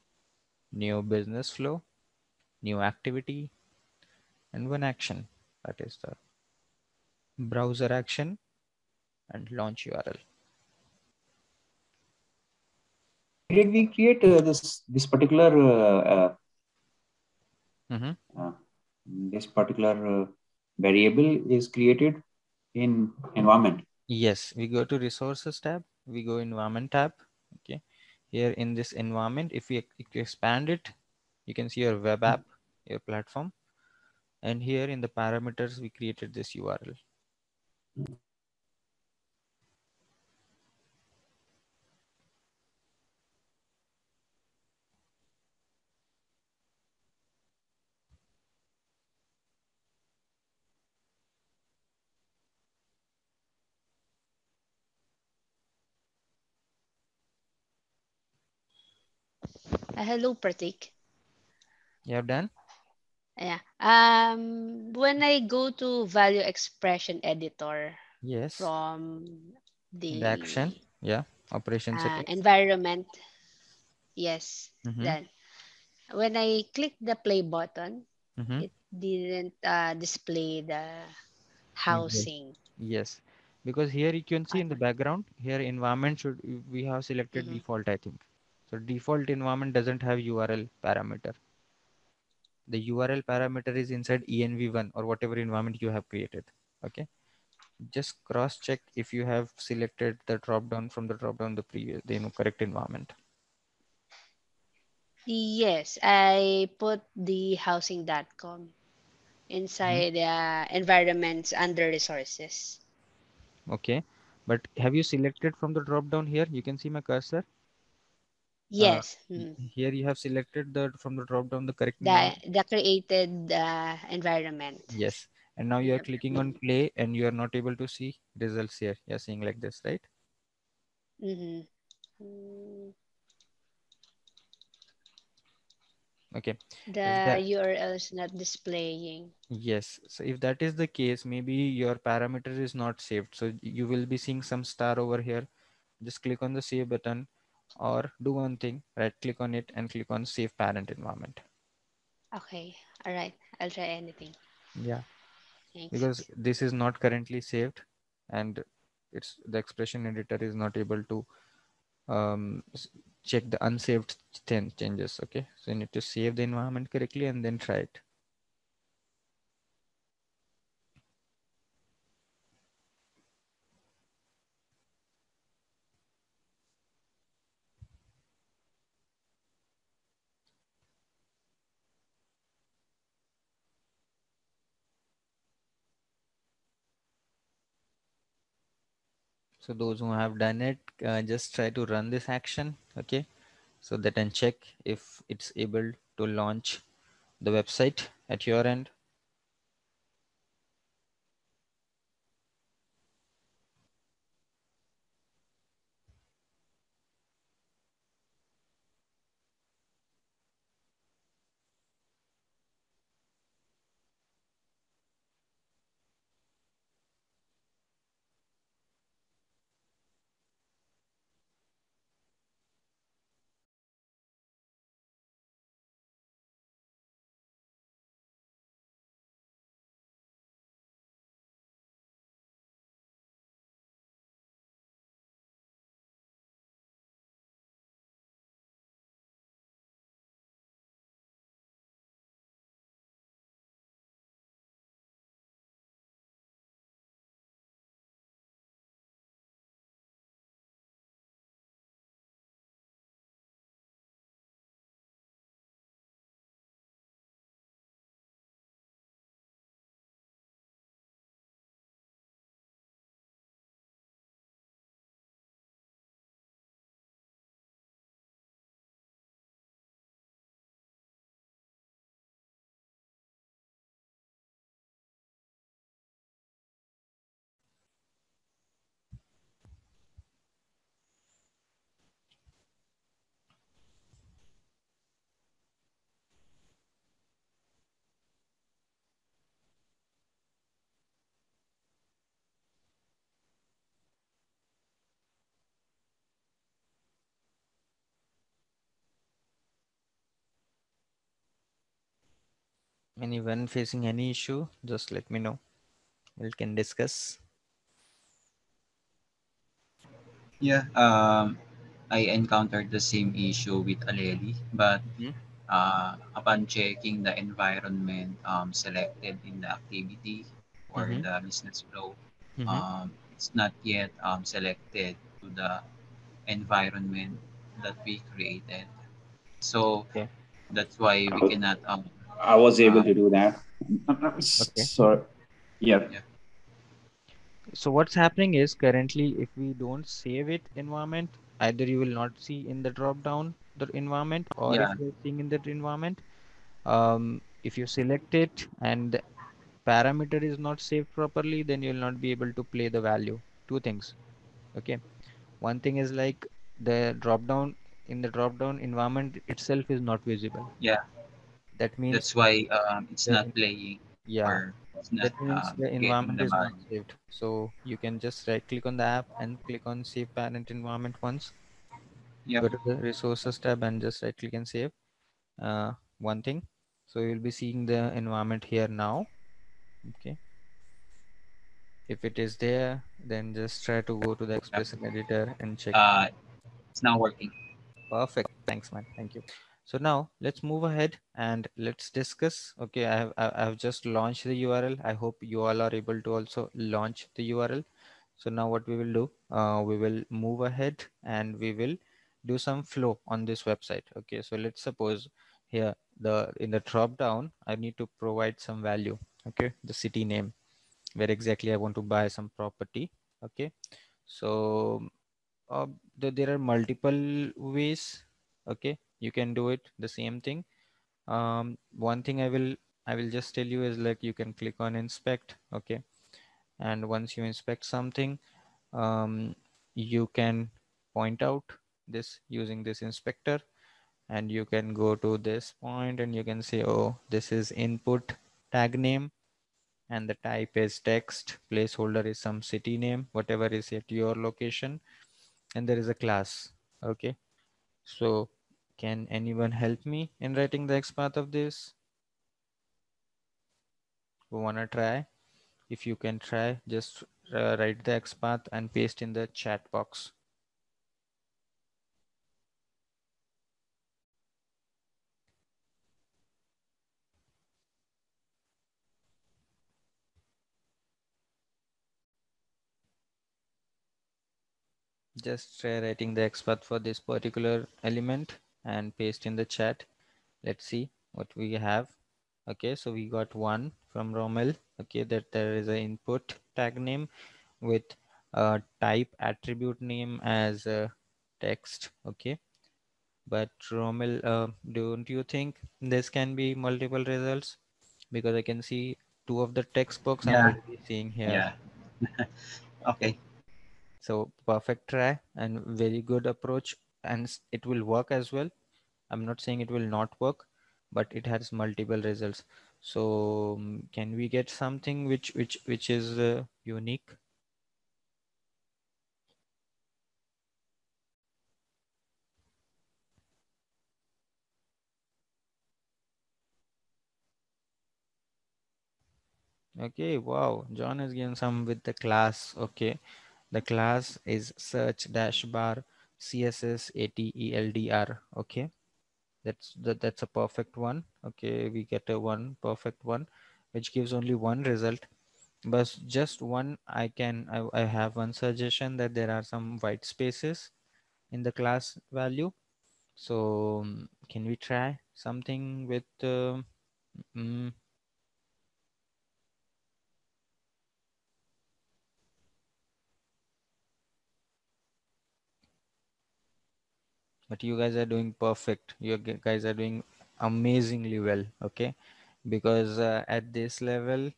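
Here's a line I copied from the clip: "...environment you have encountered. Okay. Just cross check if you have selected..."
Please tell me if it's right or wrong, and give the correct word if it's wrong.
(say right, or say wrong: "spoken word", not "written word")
wrong: "created", not "encountered".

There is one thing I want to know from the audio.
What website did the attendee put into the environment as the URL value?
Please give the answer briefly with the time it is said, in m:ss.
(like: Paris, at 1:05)
housing.com, at 1:47.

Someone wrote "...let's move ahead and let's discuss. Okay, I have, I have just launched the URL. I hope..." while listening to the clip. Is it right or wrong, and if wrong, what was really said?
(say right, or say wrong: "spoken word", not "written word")
right.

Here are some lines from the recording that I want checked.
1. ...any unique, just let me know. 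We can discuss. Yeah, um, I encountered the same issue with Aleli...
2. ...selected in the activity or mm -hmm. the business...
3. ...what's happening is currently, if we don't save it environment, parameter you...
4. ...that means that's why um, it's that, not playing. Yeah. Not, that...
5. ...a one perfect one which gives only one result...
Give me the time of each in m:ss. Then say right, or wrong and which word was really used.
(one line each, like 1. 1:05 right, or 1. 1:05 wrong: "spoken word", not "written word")
1. 5:04 wrong: "issue", not "unique"
2. 5:18 right
3. 5:37 wrong: "either", not "parameter"
4. 6:01 right
5. 9:02 right.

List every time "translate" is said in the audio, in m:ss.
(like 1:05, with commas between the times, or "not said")
not said.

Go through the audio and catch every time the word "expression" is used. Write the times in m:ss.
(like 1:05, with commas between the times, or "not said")
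1:06, 2:39, 6:24.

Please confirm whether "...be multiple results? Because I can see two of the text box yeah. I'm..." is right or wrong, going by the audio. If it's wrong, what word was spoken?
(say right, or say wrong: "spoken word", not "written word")
right.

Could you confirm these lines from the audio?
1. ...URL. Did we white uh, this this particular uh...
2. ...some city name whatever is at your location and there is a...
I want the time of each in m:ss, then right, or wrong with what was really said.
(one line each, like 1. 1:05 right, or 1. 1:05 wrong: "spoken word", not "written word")
1. 0:09 wrong: "create", not "white"
2. 7:22 right.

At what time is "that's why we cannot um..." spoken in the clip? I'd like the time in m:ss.
5:30.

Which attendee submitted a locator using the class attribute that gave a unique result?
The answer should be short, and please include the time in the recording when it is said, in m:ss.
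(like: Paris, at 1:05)
John, at 8:50.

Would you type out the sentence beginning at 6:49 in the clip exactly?
Okay, the city name, where exactly I want to buy some property.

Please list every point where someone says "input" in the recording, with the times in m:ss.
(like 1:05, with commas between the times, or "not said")
7:17, 8:05.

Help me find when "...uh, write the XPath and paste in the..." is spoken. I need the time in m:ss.
7:37.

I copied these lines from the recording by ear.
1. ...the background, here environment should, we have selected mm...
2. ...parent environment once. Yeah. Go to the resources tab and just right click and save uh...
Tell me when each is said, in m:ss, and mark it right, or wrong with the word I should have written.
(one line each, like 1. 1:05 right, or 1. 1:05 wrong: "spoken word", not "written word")
1. 1:24 right
2. 6:10 right.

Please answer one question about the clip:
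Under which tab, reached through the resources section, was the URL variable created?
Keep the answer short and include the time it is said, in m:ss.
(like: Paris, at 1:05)
Environment tab, at 0:26.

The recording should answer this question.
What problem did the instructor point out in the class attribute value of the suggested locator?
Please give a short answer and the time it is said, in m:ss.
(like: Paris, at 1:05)
white spaces, at 9:09.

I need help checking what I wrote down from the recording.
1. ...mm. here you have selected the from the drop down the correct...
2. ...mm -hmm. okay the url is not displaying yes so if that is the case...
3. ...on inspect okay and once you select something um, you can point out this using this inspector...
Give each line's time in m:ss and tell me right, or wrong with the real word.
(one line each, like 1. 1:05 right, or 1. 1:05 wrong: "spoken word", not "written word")
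1. 1:59 right
2. 2:11 right
3. 7:04 wrong: "inspect", not "select".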